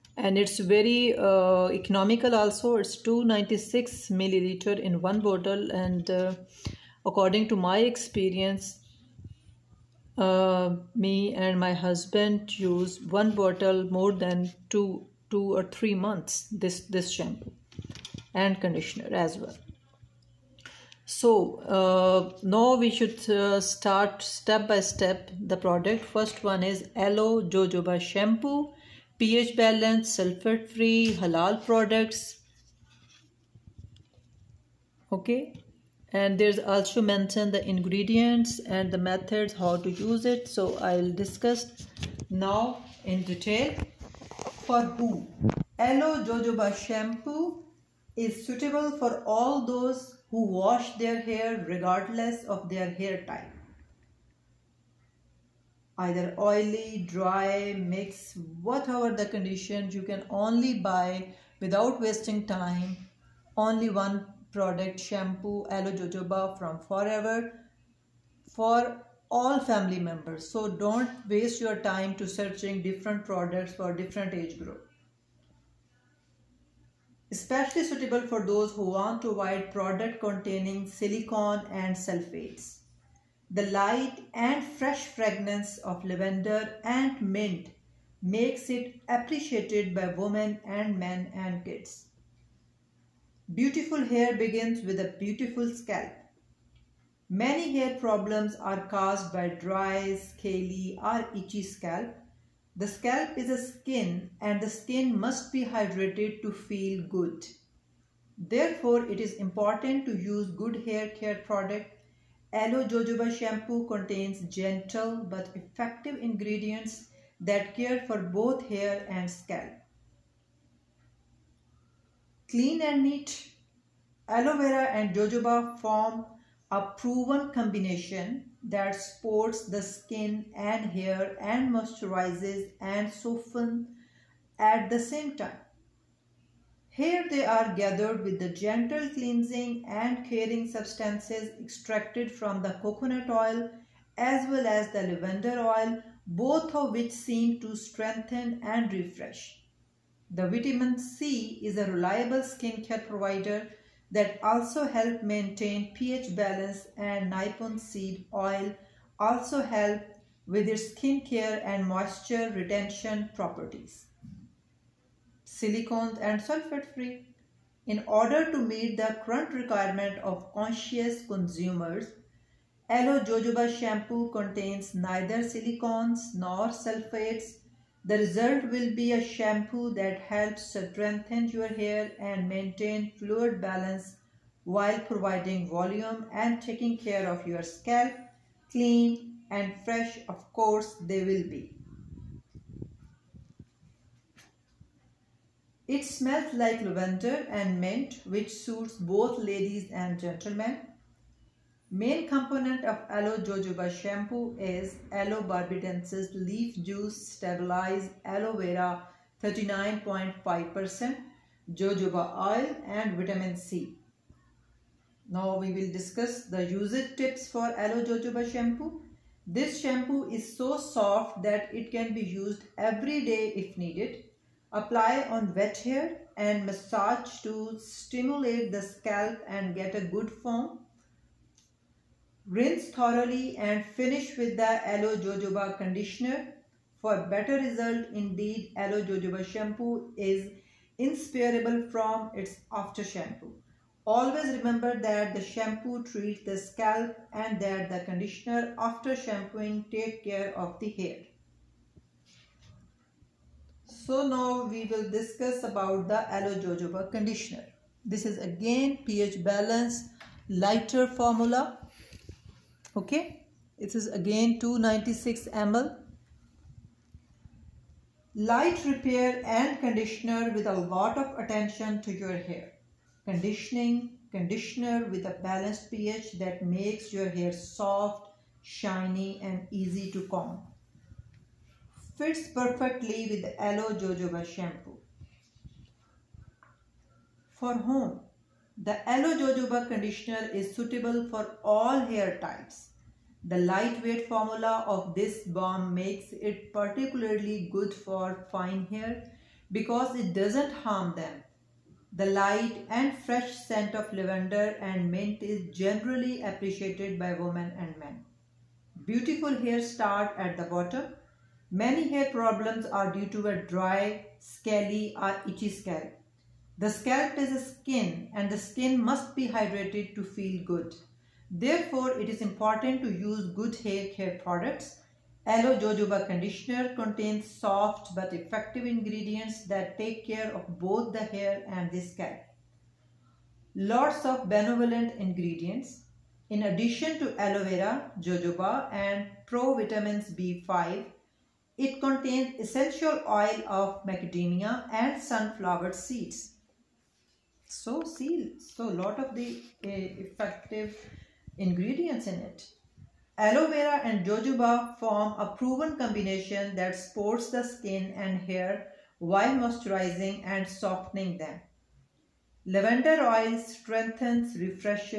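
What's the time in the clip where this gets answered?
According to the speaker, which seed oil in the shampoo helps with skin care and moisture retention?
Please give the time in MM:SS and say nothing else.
02:37.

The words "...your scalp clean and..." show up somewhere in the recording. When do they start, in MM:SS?
03:07.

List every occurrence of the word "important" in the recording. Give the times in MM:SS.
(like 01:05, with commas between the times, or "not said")
01:49, 05:22.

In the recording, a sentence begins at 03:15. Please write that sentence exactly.
It smells like lavender and mint which suits both ladies and gentlemen.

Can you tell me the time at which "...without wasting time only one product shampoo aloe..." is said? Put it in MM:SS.
01:01.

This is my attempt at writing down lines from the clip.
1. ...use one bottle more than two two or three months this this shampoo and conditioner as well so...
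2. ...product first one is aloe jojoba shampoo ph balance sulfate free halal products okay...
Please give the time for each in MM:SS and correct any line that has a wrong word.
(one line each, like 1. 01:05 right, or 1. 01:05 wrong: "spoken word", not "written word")
1. 00:12 right
2. 00:25 right.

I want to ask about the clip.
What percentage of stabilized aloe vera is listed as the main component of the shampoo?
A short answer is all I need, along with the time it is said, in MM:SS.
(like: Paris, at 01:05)
39.5%, at 03:29.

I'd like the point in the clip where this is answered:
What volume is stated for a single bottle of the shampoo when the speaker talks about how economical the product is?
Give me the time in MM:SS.
00:03.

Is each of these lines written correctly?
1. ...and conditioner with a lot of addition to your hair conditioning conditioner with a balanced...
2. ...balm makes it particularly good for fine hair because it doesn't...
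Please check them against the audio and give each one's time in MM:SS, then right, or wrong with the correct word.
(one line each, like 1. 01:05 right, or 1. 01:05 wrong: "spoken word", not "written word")
1. 04:29 wrong: "attention", not "addition"
2. 04:55 right.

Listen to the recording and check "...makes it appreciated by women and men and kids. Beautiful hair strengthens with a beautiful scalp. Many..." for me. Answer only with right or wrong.
wrong.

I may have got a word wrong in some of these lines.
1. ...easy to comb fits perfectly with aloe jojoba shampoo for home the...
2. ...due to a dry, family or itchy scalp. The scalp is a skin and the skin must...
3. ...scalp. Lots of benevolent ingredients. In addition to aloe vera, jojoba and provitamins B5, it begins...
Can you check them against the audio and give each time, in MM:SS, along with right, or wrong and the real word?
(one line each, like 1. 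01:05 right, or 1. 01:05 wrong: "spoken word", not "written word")
1. 04:39 right
2. 05:13 wrong: "scaly", not "family"
3. 05:32 wrong: "contains", not "begins".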